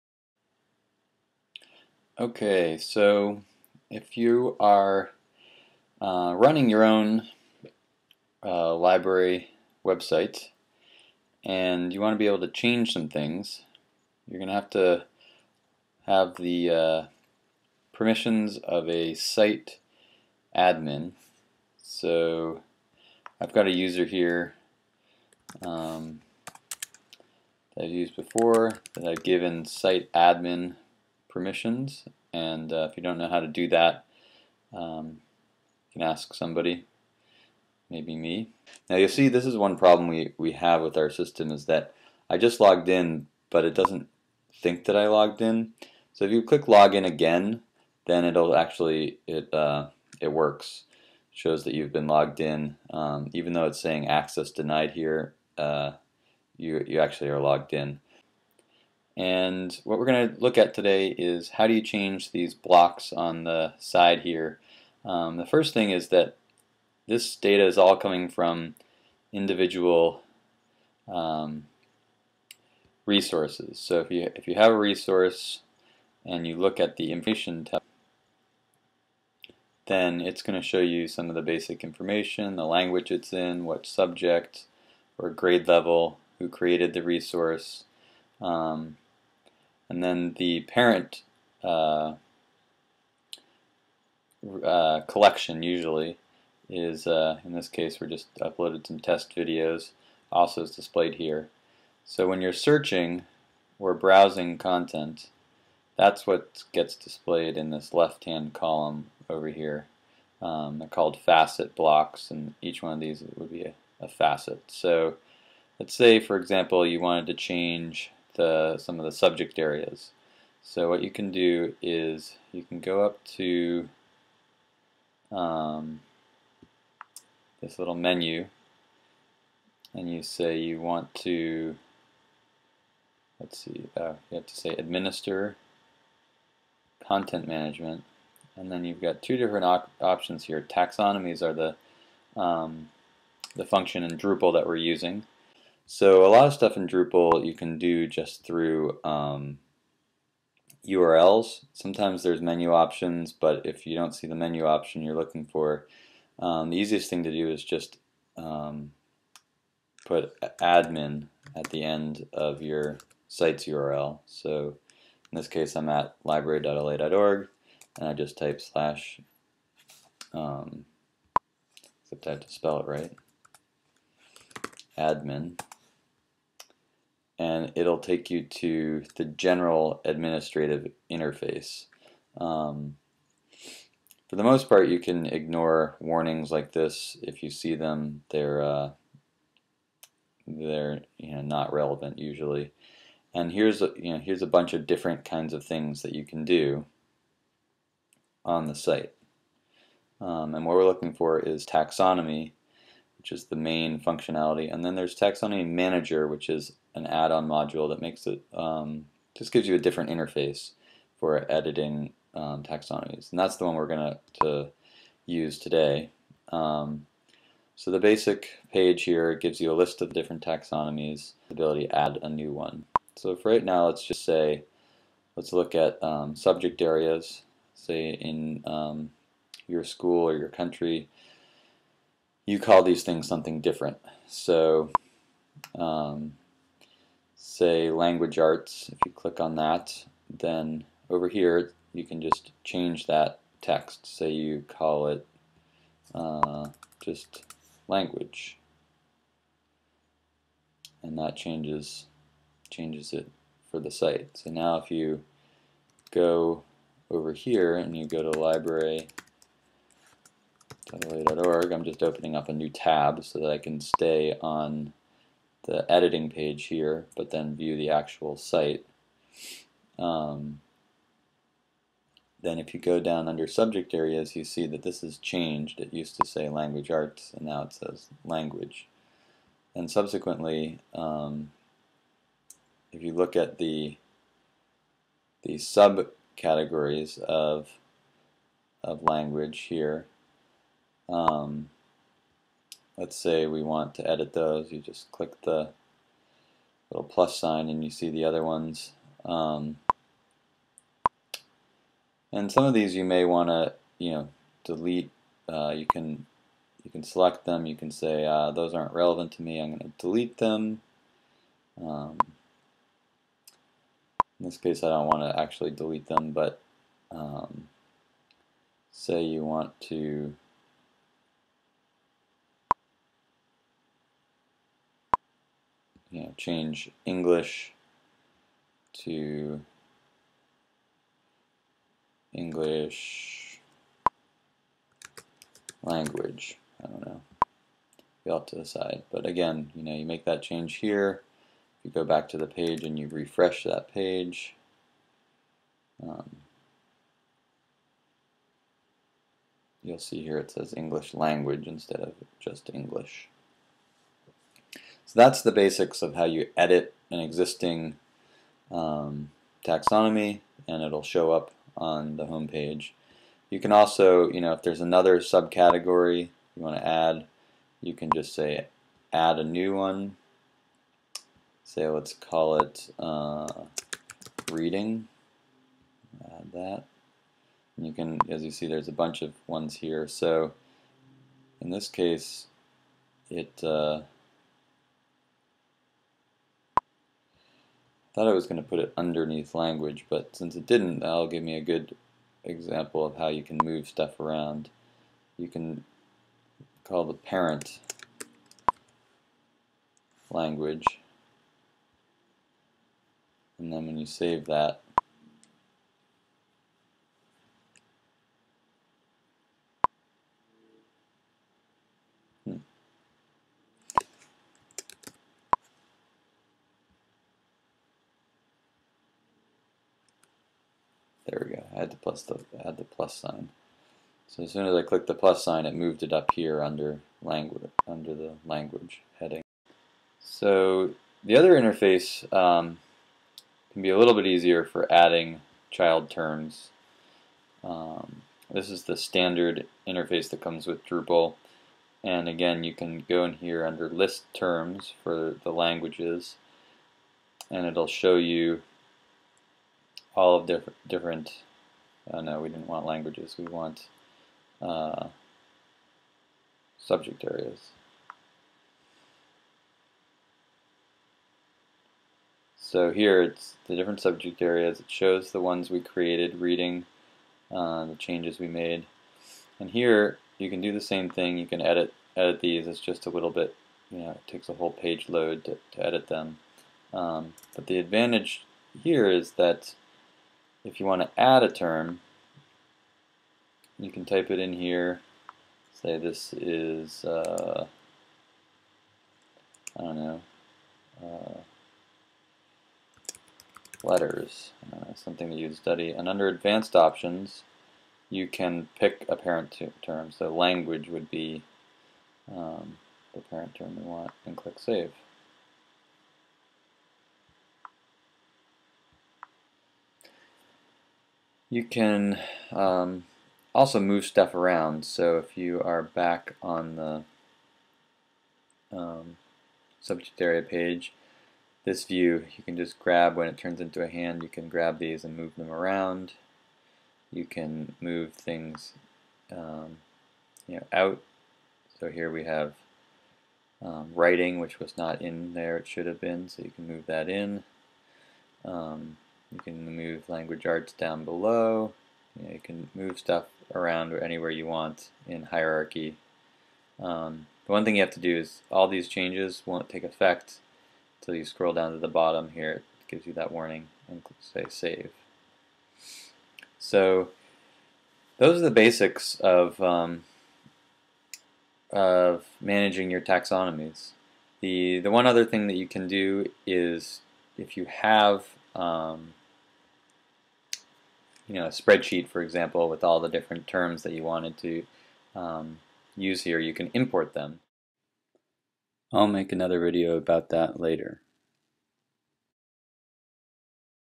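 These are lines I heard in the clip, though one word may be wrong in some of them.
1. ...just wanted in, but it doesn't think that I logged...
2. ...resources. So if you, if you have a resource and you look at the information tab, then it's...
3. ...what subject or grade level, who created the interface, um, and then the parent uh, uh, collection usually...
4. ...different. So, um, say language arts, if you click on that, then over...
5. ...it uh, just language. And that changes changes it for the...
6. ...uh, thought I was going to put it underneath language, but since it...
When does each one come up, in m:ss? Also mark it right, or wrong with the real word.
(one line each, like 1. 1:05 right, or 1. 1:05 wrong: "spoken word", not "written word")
1. 0:42 wrong: "logged", not "wanted"
2. 1:13 right
3. 1:23 wrong: "resource", not "interface"
4. 3:53 right
5. 4:05 right
6. 6:23 right.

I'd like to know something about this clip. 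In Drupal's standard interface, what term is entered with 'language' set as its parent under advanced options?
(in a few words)
Letters.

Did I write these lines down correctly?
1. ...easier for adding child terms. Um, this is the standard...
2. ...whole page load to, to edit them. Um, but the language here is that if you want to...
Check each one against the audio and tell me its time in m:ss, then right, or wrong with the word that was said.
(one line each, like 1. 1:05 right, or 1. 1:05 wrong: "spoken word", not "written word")
1. 7:14 right
2. 7:54 wrong: "advantage", not "language".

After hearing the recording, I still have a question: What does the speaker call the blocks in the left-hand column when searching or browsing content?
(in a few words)
Facet blocks.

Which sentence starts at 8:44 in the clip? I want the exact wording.
You can grab these and move them around.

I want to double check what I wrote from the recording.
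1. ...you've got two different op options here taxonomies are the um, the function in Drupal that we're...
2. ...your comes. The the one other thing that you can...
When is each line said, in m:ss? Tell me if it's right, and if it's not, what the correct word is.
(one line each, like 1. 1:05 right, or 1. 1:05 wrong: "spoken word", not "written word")
1. 2:18 right
2. 9:22 wrong: "taxonomies", not "comes".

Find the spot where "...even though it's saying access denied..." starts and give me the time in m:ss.
0:53.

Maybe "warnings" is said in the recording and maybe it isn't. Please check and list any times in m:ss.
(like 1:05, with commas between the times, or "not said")
3:05, 9:13.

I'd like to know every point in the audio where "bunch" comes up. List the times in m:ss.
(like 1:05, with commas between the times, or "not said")
3:14, 6:18.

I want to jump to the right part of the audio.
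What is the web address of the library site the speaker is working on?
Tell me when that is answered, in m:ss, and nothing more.
2:46.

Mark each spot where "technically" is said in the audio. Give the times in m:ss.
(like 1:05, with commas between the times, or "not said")
not said.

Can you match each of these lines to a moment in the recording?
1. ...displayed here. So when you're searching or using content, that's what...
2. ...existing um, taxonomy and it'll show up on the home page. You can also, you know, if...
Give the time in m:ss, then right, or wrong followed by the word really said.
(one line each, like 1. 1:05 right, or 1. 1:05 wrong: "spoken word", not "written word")
1. 1:40 wrong: "browsing", not "using"
2. 5:57 right.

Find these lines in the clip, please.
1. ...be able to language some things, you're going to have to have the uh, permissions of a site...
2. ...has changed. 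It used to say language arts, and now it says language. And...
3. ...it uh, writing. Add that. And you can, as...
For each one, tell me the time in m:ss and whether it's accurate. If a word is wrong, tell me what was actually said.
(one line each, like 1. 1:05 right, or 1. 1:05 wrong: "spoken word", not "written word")
1. 0:12 wrong: "change", not "language"
2. 4:35 right
3. 6:12 wrong: "reading", not "writing".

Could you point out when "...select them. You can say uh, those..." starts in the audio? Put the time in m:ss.
5:07.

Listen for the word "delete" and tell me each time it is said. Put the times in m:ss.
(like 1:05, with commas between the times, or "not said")
5:04, 5:09, 5:15.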